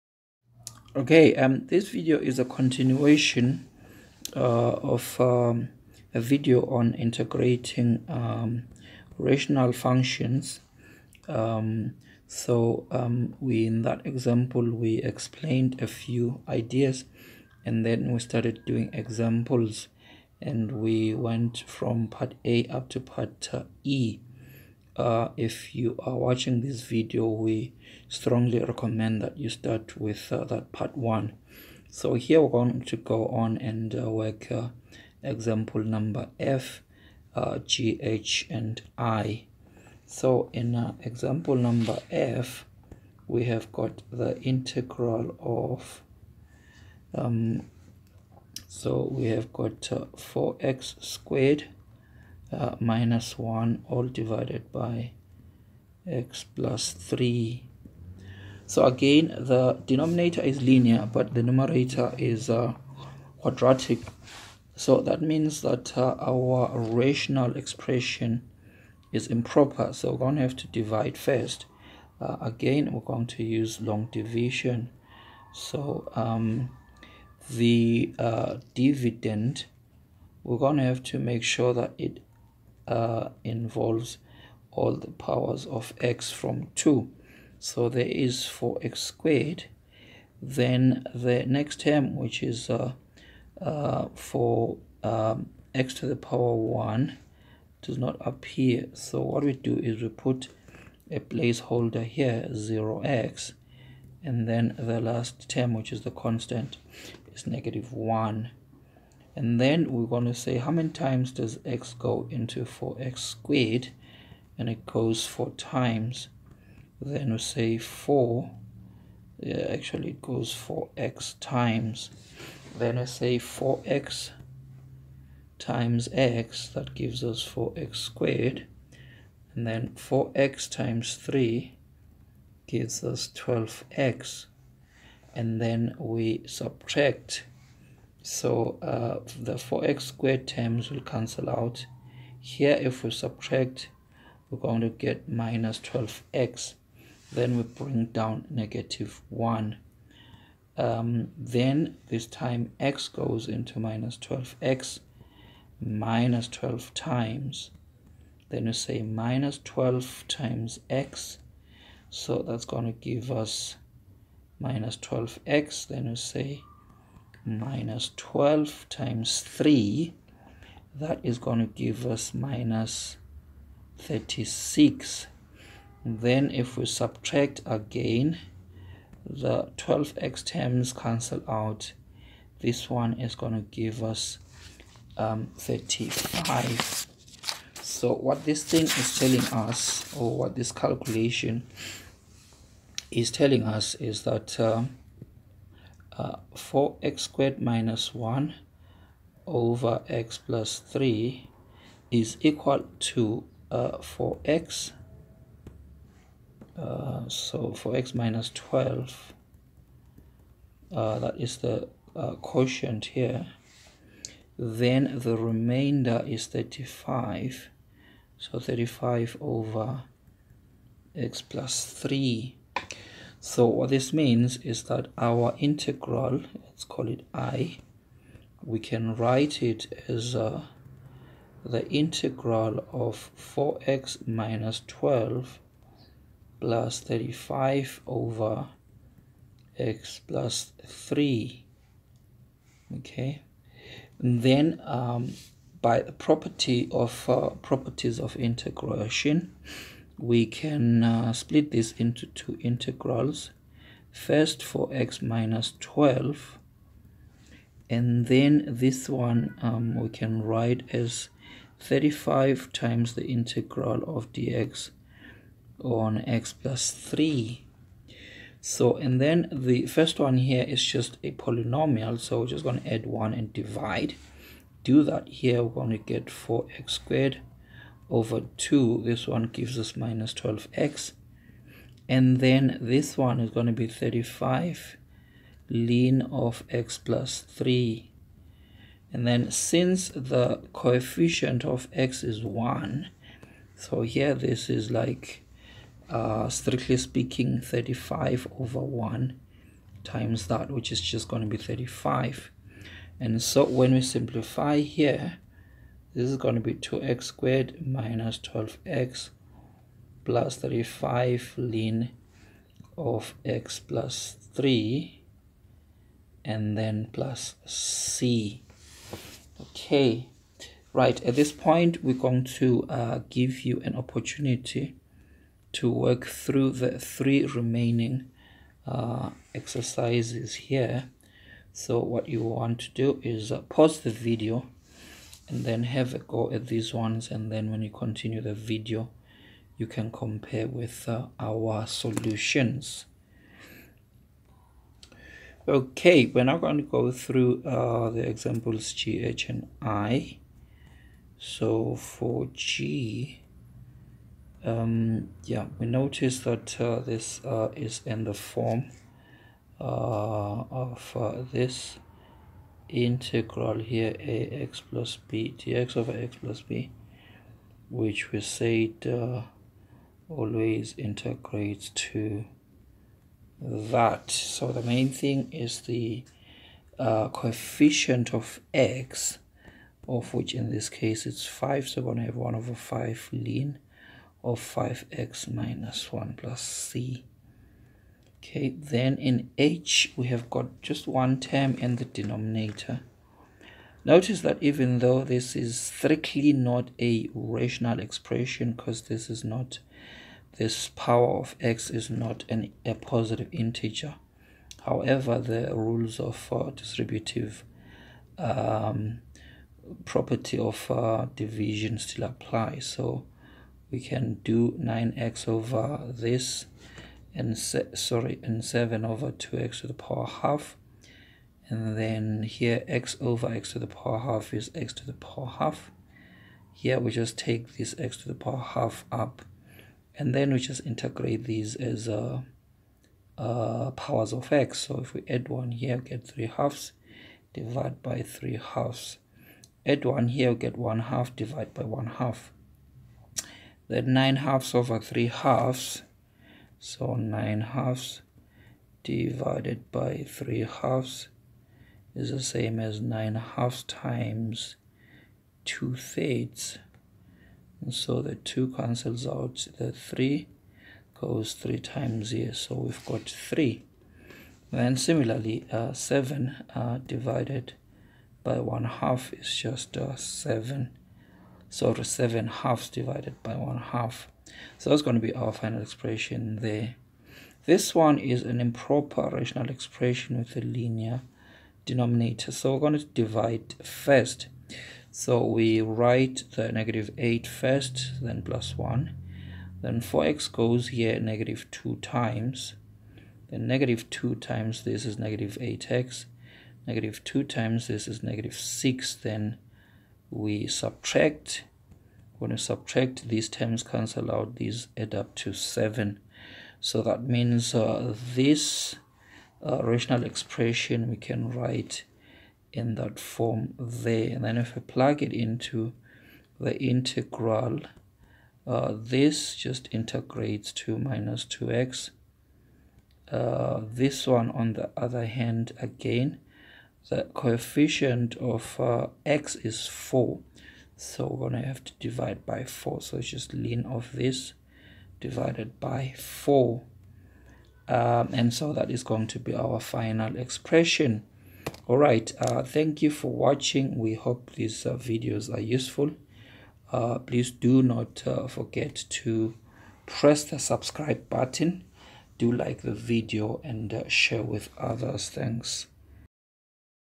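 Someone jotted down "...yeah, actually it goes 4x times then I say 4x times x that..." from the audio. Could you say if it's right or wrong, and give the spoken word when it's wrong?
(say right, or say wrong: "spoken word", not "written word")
right.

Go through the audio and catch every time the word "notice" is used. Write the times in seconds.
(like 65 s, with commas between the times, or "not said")
355 s, 394 s.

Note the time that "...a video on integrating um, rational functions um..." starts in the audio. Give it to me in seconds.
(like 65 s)
6 s.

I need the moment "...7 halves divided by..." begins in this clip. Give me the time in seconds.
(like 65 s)
471 s.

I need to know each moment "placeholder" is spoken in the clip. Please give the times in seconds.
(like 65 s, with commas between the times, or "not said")
101 s.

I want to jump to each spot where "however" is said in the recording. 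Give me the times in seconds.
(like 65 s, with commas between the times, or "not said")
404 s.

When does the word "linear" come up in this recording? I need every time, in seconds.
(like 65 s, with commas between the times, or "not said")
60 s, 480 s.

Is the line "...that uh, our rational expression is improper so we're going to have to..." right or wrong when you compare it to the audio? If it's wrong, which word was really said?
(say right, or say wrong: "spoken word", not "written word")
right.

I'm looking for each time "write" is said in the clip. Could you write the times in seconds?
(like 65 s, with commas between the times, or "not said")
229 s, 260 s, 485 s, 511 s.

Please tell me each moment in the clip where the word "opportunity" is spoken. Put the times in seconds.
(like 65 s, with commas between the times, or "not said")
323 s.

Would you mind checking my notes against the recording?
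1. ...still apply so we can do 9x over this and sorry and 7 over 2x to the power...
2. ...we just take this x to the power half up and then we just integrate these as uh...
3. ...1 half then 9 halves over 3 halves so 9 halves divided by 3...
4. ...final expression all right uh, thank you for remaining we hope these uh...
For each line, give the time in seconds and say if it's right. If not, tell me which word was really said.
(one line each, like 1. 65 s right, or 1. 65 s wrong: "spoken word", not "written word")
1. 411 s right
2. 426 s right
3. 441 s right
4. 539 s wrong: "watching", not "remaining".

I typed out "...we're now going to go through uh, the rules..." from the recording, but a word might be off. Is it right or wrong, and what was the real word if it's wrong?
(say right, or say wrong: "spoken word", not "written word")
wrong: "examples", not "rules".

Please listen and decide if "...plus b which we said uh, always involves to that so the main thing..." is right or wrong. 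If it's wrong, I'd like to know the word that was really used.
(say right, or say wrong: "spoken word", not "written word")
wrong: "integrates", not "involves".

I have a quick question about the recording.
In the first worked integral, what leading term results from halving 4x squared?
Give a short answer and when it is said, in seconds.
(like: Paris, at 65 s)
2x squared, at 306 s.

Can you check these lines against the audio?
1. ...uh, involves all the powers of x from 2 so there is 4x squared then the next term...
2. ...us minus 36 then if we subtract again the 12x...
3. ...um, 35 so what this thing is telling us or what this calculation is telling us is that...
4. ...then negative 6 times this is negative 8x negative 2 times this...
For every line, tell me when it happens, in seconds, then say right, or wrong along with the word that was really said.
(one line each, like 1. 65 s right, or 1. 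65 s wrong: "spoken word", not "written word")
1. 82 s right
2. 172 s right
3. 185 s right
4. 493 s wrong: "2", not "6".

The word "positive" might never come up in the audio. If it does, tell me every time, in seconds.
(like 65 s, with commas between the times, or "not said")
402 s.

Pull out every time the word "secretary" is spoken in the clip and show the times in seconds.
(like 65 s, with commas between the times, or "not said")
not said.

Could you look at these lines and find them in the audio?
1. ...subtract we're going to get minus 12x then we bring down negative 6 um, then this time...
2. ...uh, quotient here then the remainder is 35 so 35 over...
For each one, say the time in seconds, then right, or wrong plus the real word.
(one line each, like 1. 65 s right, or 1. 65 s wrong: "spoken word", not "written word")
1. 143 s wrong: "1", not "6"
2. 212 s right.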